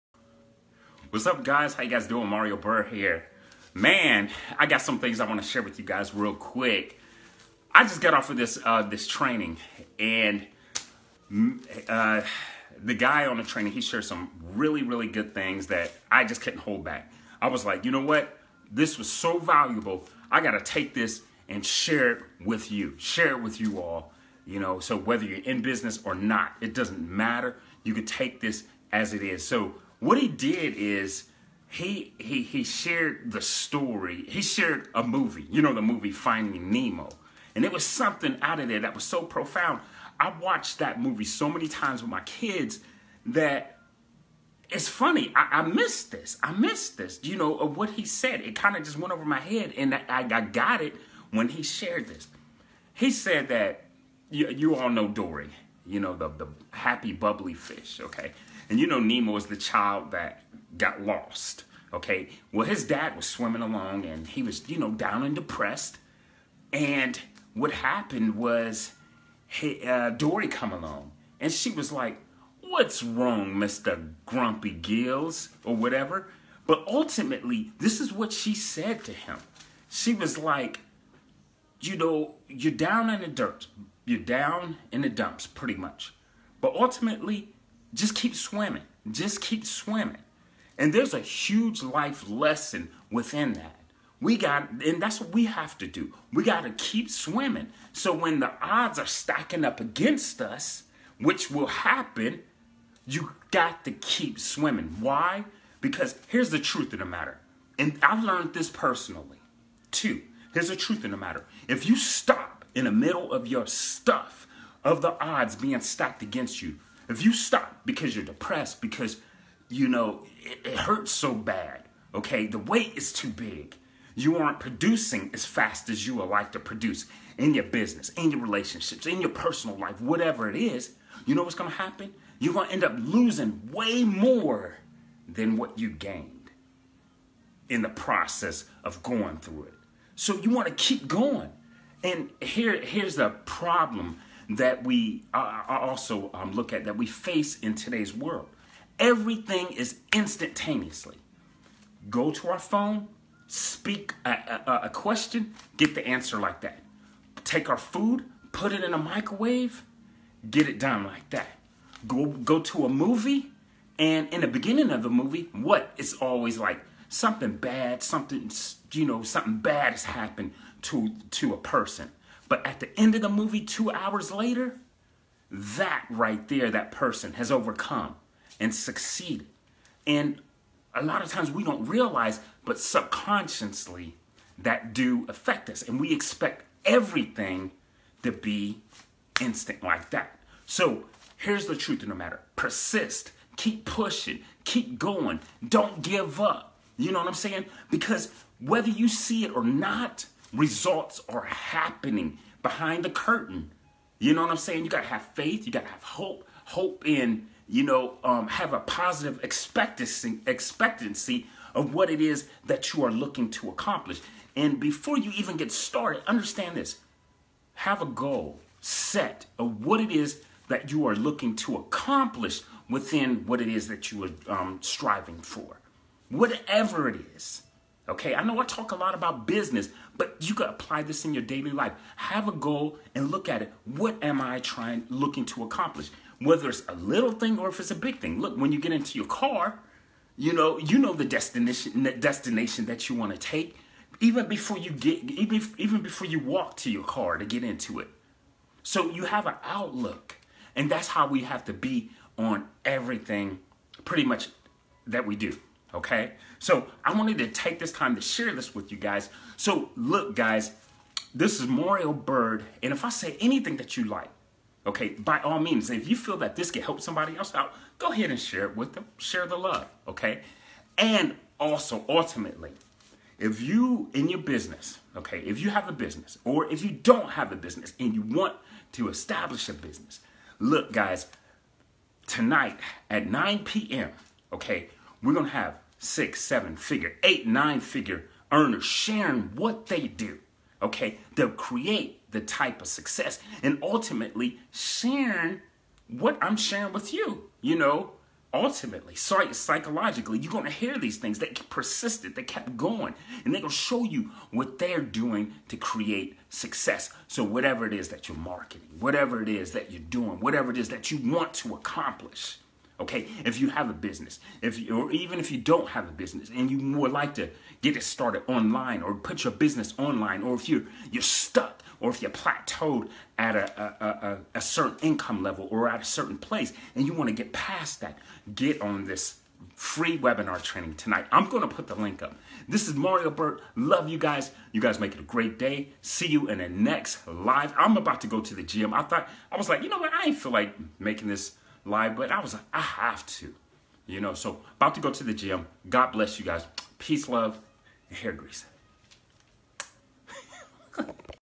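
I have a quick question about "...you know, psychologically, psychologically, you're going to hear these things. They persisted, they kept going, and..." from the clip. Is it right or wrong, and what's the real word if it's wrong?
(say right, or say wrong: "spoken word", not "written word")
wrong: "ultimately", not "psychologically".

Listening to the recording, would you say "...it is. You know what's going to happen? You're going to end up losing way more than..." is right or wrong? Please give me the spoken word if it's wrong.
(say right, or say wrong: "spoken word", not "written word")
right.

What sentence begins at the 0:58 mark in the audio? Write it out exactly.
And you know Nemo is the child that got lost, okay?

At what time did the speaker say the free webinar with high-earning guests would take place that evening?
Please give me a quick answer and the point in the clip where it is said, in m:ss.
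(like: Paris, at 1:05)
9 p.m., at 4:43.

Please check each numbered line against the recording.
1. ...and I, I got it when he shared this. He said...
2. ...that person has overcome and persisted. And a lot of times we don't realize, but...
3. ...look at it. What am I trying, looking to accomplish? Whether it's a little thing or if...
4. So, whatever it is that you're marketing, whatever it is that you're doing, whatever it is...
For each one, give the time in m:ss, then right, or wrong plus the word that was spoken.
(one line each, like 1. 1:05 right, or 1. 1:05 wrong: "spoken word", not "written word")
1. 0:49 right
2. 2:56 wrong: "succeeded", not "persisted"
3. 3:53 right
4. 5:07 right.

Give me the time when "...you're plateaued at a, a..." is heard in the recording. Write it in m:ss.
5:22.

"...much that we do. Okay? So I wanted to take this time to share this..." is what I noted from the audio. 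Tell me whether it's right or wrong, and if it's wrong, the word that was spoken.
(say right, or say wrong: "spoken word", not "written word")
right.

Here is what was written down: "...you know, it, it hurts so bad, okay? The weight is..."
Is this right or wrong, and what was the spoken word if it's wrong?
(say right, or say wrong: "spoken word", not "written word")
right.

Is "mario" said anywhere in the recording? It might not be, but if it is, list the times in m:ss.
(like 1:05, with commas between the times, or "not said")
0:02, 4:21, 5:32.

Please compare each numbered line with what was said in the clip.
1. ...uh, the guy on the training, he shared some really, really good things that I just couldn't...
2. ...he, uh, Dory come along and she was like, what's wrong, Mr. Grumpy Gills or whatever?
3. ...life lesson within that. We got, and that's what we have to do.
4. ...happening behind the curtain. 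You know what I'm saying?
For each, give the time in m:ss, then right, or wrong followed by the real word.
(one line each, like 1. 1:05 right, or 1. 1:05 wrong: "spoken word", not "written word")
1. 0:11 right
2. 1:09 right
3. 1:31 right
4. 3:21 right.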